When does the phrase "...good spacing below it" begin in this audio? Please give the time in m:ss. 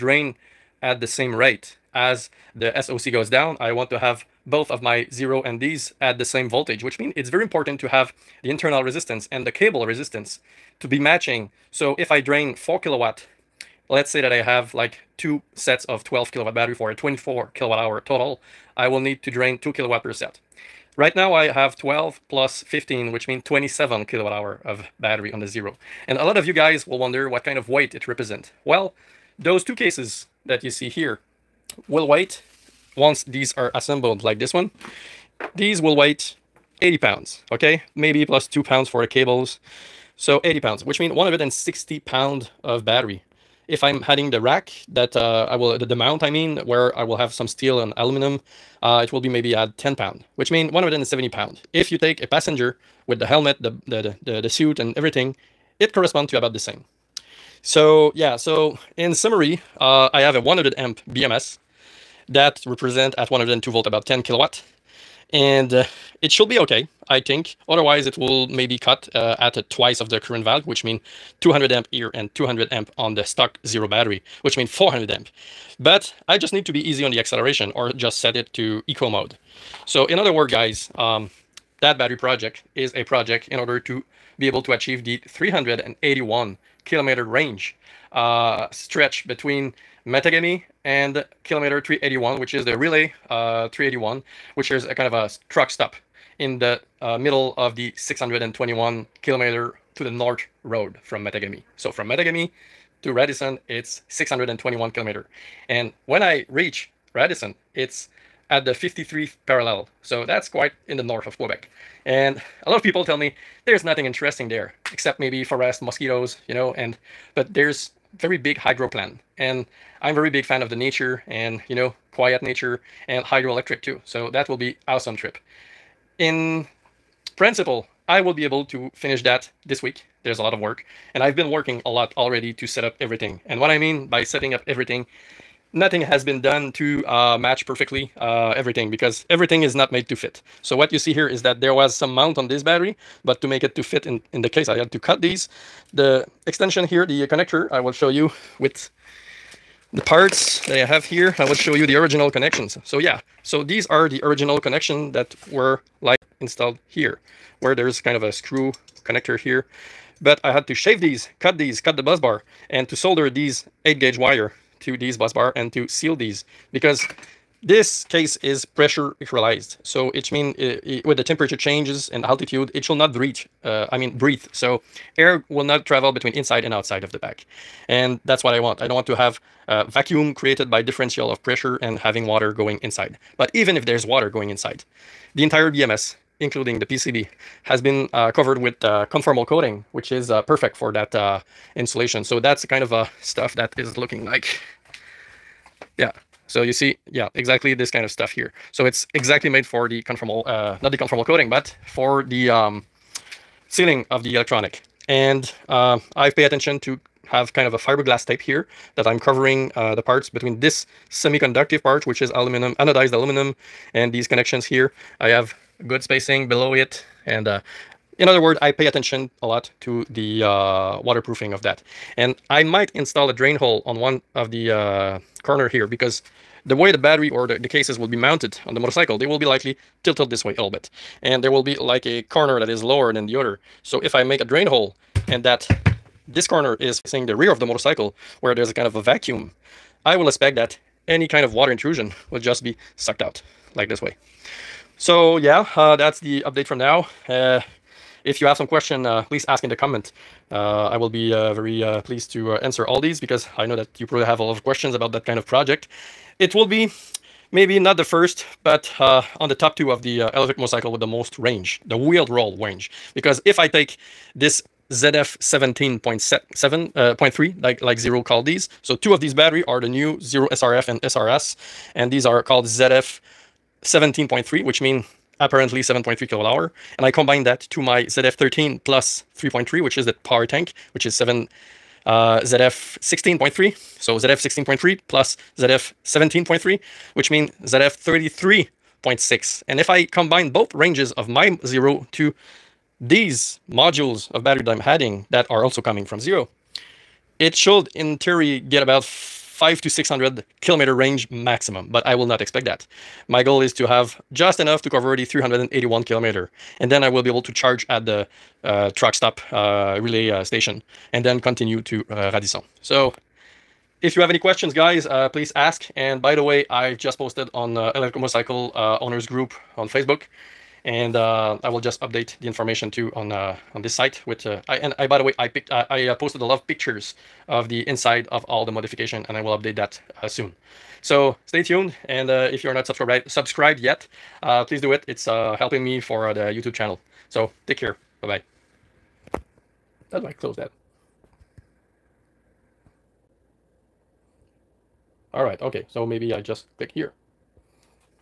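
3:35.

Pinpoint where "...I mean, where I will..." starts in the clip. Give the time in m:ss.
0:46.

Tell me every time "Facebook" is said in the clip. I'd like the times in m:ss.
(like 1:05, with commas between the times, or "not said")
5:19.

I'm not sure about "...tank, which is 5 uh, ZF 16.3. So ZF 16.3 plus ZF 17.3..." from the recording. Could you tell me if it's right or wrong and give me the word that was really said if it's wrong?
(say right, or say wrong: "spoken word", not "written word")
wrong: "7", not "5".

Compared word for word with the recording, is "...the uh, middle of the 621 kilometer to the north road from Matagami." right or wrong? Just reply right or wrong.
right.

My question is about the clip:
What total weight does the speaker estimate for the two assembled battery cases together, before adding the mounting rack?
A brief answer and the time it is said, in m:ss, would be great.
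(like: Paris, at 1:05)
160 pounds, at 0:41.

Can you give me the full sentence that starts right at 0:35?
These will weight 80 pounds, okay?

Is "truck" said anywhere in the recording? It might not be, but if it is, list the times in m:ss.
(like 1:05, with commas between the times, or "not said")
1:35, 5:08.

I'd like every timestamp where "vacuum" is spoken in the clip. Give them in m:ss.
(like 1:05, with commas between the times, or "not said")
2:59, 3:59.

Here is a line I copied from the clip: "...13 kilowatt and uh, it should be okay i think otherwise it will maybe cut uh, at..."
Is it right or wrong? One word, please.
wrong.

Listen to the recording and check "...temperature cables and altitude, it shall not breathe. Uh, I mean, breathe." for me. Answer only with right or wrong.
wrong.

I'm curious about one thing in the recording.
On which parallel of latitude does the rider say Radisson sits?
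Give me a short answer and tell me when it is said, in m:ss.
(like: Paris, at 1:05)
53th parallel, at 1:48.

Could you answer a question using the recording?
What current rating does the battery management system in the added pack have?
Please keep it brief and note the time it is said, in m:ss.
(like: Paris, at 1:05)
100 amp, at 1:00.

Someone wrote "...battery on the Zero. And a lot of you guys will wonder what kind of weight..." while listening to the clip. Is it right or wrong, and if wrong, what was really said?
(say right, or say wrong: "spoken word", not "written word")
right.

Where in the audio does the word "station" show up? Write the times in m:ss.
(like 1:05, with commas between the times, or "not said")
5:10.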